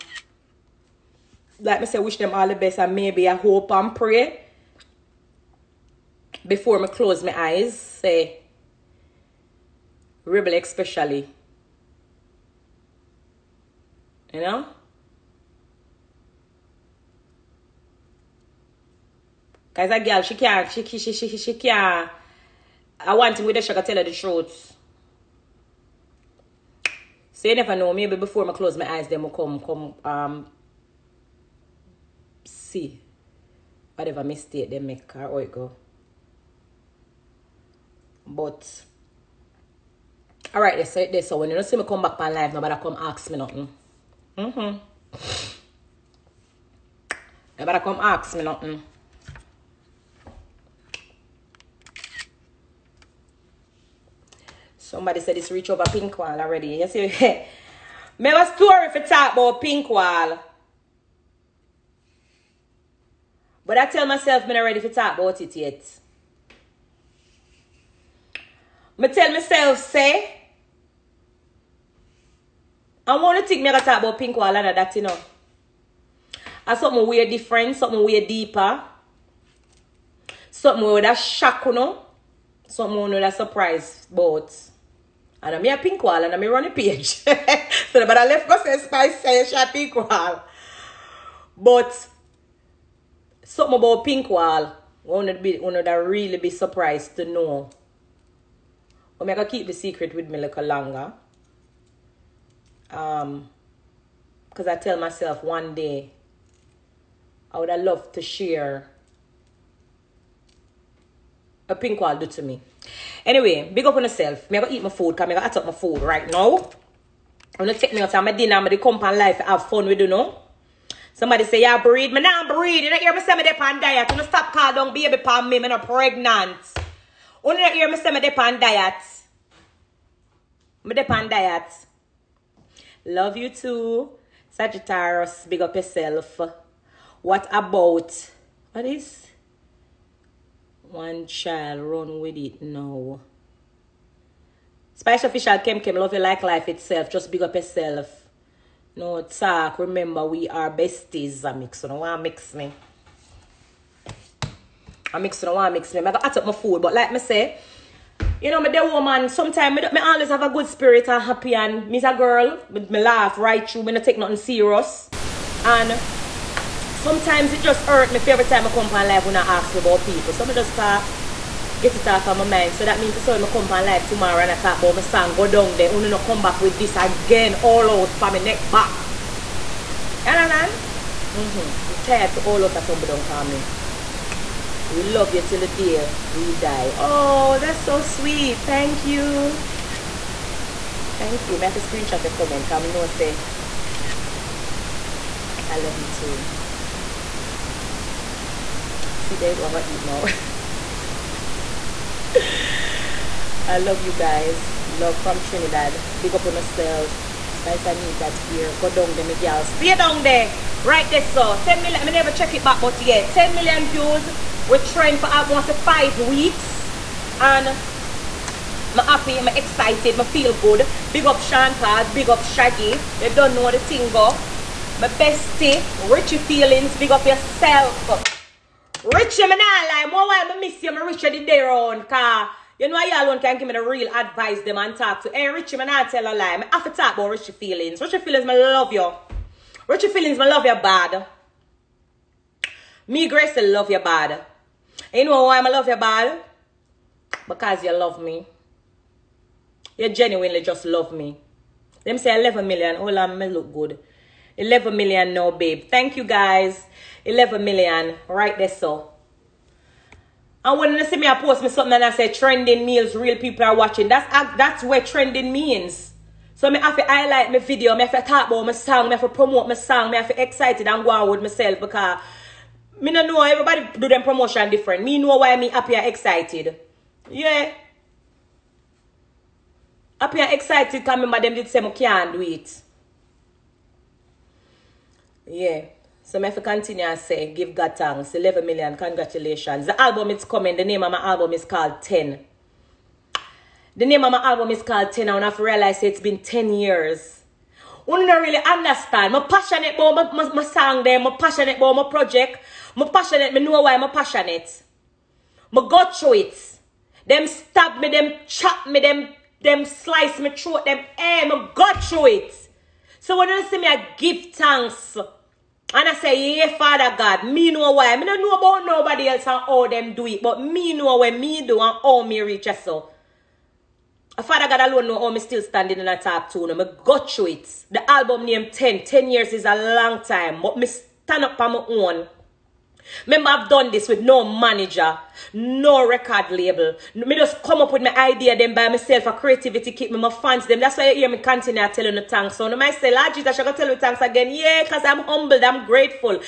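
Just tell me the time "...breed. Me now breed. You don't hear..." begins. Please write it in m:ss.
2:01.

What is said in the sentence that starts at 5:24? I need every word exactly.
Father God alone know how me still standing in a top two.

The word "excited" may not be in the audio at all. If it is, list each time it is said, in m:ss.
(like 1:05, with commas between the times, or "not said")
3:39, 4:30, 4:36, 4:40.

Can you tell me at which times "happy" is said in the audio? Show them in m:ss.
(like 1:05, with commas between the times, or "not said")
2:41, 3:39, 4:35, 4:40.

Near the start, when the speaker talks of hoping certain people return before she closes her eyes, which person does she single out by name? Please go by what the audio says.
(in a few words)
Rebel.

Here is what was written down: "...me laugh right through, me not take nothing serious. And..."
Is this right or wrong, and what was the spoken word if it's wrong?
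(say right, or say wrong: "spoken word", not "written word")
right.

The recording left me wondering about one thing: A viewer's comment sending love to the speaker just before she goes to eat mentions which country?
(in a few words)
Trinidad.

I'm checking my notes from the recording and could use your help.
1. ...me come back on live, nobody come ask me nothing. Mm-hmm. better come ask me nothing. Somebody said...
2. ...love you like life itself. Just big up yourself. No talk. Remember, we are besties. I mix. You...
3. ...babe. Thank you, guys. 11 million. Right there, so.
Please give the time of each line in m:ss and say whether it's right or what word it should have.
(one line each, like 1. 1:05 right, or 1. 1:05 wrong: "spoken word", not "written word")
1. 0:41 right
2. 2:25 right
3. 4:15 right.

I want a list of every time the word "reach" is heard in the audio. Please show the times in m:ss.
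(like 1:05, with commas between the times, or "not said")
0:55, 5:22.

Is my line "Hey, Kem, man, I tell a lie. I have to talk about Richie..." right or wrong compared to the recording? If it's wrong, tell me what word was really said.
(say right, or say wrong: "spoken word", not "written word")
wrong: "Richie", not "Kem".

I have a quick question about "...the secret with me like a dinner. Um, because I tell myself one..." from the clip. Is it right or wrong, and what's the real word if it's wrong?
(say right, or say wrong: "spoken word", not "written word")
wrong: "longer", not "dinner".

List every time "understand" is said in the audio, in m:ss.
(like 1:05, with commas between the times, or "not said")
3:00, 4:58.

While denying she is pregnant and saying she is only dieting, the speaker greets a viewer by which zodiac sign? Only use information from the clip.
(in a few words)
Sagittarius.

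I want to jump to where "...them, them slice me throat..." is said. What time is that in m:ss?
5:08.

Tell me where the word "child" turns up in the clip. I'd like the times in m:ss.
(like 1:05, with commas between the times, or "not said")
2:21.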